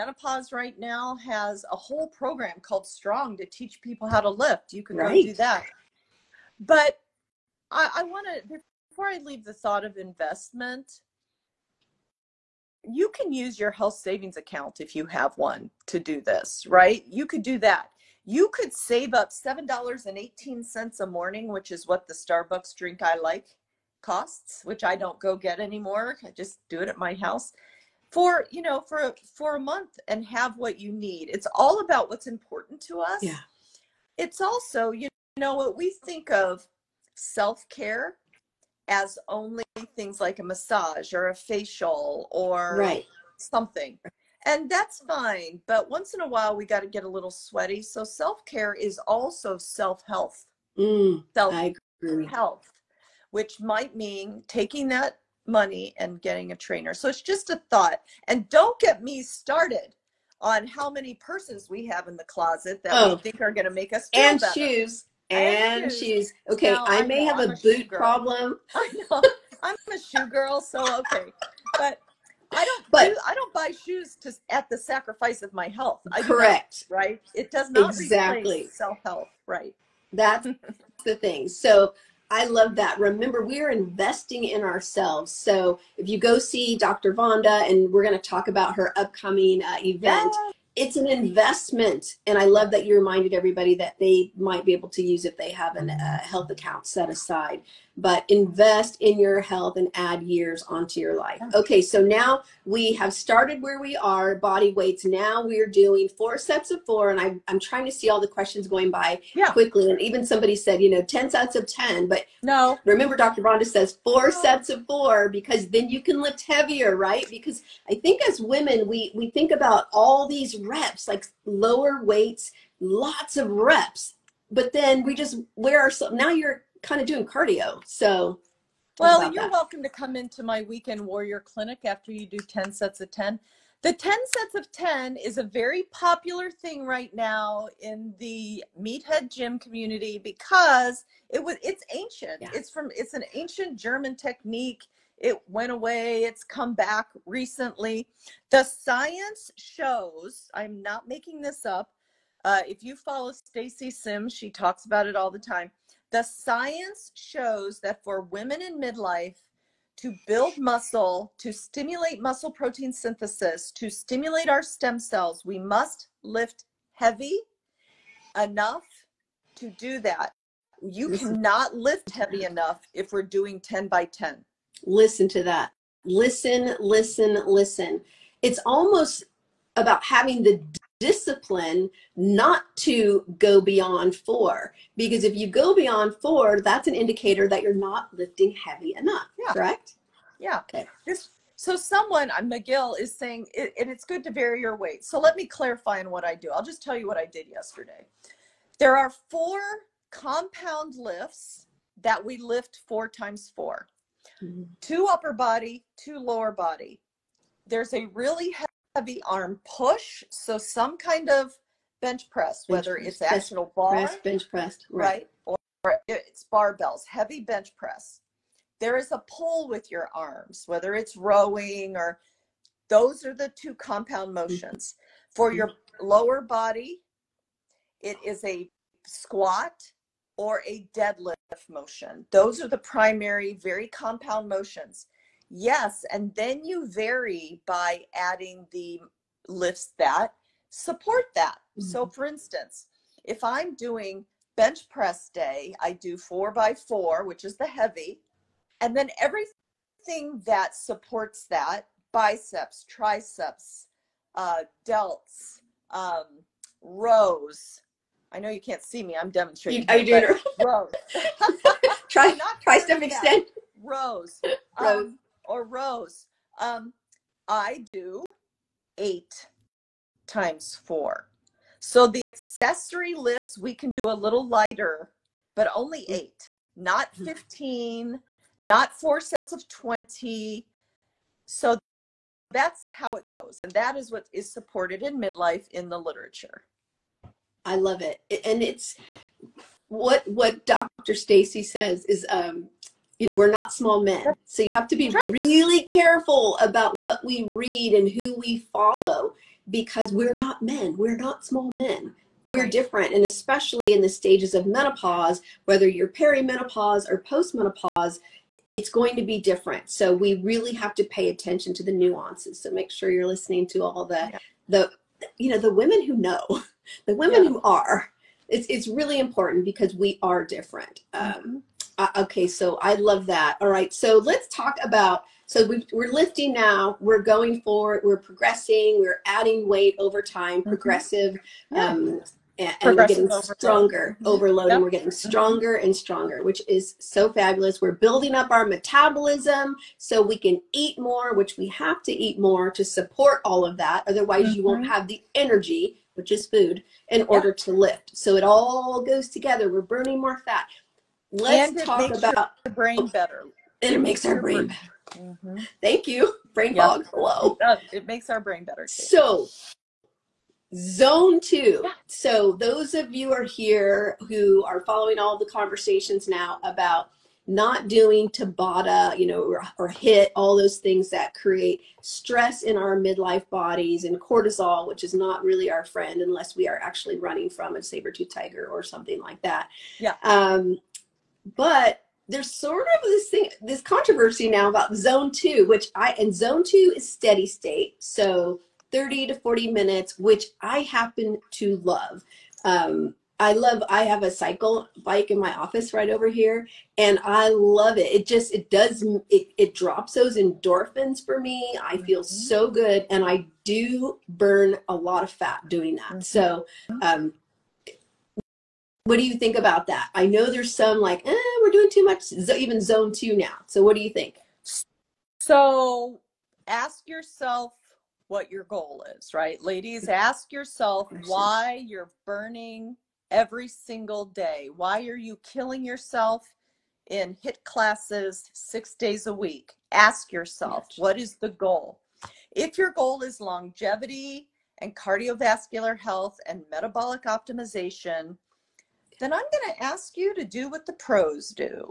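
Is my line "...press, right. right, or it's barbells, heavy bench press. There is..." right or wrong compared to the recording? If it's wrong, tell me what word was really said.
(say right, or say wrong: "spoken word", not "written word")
right.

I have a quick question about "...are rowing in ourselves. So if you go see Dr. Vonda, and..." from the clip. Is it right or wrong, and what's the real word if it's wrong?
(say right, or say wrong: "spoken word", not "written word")
wrong: "investing", not "rowing".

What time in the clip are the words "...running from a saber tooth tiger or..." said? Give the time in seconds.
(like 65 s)
377 s.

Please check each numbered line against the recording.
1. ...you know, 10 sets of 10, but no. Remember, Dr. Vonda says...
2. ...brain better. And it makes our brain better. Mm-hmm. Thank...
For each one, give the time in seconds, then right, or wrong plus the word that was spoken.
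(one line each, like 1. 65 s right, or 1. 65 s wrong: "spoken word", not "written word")
1. 110 s right
2. 352 s right.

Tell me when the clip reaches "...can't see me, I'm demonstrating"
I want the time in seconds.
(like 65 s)
258 s.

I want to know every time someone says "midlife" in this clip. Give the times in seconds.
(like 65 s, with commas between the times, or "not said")
158 s, 285 s, 372 s.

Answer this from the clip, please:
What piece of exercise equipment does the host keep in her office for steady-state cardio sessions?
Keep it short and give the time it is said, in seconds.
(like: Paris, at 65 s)
cycle bike, at 394 s.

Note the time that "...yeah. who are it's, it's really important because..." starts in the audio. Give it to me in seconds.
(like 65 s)
317 s.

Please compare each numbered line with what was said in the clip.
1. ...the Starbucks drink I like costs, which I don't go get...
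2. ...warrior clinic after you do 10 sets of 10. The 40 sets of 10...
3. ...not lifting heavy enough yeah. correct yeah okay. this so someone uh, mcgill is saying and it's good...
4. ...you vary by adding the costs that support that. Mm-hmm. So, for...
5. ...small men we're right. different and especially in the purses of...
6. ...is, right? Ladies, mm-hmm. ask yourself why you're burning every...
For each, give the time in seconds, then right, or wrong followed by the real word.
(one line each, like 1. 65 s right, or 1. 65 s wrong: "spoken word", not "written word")
1. 22 s right
2. 130 s wrong: "10", not "40"
3. 187 s right
4. 236 s wrong: "lifts", not "costs"
5. 301 s wrong: "stages", not "purses"
6. 419 s right.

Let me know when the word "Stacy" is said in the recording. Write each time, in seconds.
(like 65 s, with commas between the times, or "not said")
153 s, 291 s.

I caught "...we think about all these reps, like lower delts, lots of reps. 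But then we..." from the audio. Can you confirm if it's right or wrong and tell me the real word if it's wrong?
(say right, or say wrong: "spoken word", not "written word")
wrong: "weights", not "delts".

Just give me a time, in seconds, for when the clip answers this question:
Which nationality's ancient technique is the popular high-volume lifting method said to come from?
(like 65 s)
143 s.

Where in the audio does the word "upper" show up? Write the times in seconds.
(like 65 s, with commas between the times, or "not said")
205 s.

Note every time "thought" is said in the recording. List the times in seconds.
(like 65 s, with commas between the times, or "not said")
9 s, 57 s.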